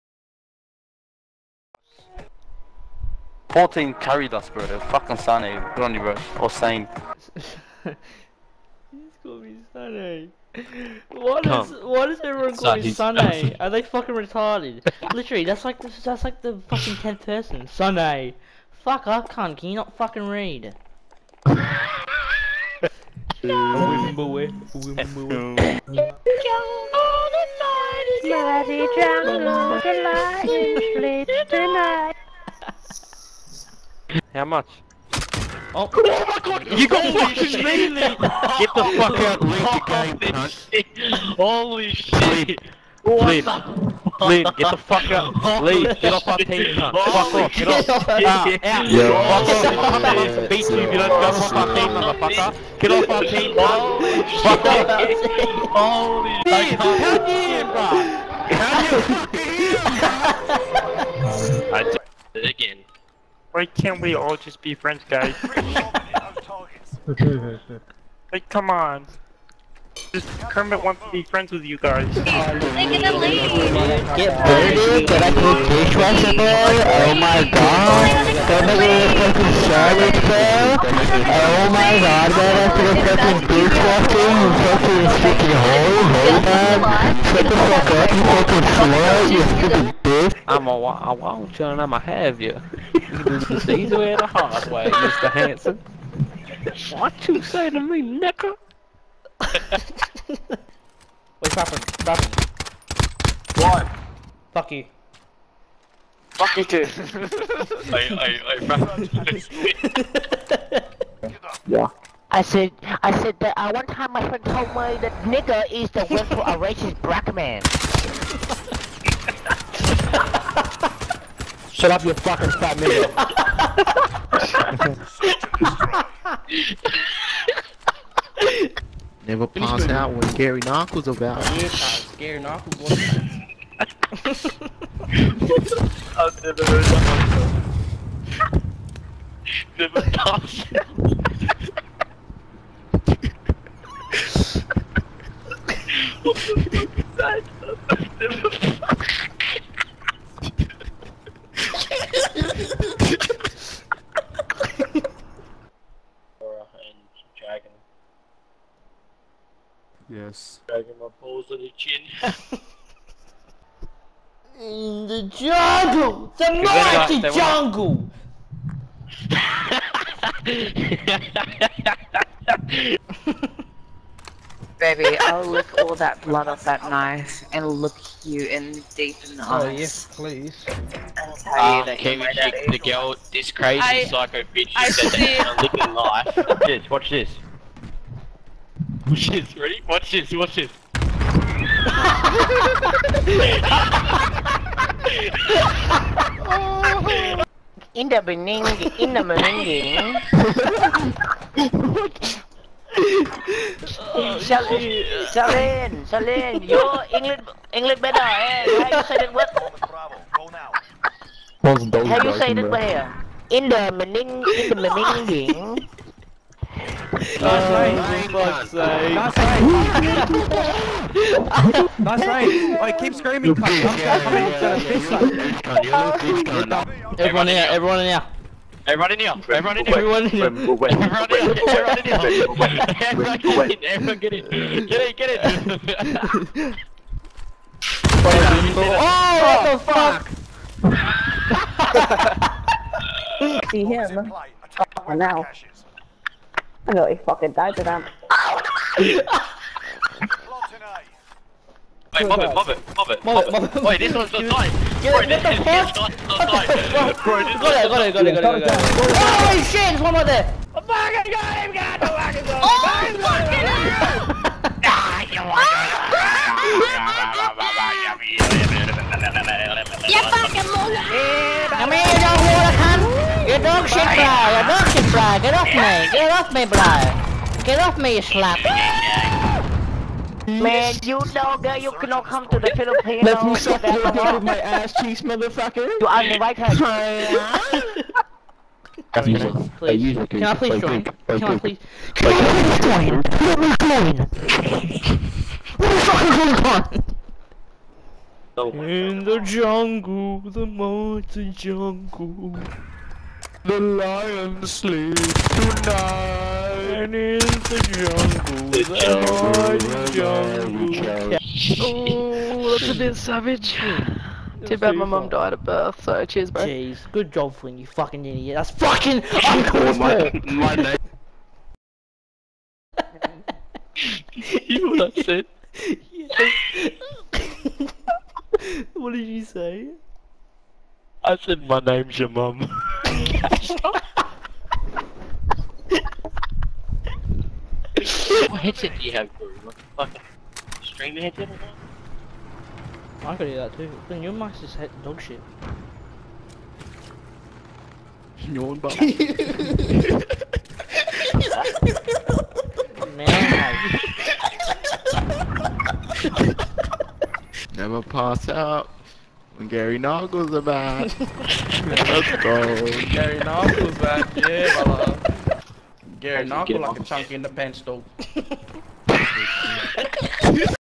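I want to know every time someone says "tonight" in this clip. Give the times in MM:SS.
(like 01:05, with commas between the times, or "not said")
00:31, 05:05.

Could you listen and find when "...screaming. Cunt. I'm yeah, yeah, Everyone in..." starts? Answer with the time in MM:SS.
03:43.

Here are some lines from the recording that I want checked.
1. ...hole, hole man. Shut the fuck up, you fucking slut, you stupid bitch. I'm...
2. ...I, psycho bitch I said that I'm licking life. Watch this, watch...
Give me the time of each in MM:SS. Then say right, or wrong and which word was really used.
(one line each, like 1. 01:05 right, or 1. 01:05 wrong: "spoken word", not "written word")
1. 01:25 right
2. 03:03 right.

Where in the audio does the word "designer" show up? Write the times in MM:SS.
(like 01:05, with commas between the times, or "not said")
not said.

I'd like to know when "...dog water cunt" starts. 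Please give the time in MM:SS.
04:32.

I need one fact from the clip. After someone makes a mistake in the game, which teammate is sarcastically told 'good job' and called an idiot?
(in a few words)
Flynn.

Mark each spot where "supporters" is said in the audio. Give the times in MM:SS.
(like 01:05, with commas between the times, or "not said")
not said.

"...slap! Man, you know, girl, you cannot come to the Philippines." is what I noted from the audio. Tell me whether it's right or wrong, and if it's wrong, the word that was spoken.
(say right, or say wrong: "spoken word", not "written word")
right.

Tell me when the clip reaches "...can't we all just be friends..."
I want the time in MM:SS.
01:03.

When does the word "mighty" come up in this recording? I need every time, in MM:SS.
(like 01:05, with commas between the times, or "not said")
02:46.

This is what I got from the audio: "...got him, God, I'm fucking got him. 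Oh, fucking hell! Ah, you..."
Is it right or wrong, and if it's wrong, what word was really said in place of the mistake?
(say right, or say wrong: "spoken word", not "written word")
right.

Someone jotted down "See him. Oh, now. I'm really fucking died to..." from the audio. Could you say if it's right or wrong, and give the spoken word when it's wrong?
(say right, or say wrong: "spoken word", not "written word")
right.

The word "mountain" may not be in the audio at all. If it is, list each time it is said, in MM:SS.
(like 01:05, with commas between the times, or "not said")
05:00.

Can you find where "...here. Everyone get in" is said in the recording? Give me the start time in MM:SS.
03:53.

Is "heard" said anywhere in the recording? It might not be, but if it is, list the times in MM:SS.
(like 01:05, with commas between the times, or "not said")
02:16.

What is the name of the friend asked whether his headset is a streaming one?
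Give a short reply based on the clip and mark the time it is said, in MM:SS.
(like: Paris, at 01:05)
Corey, at 05:39.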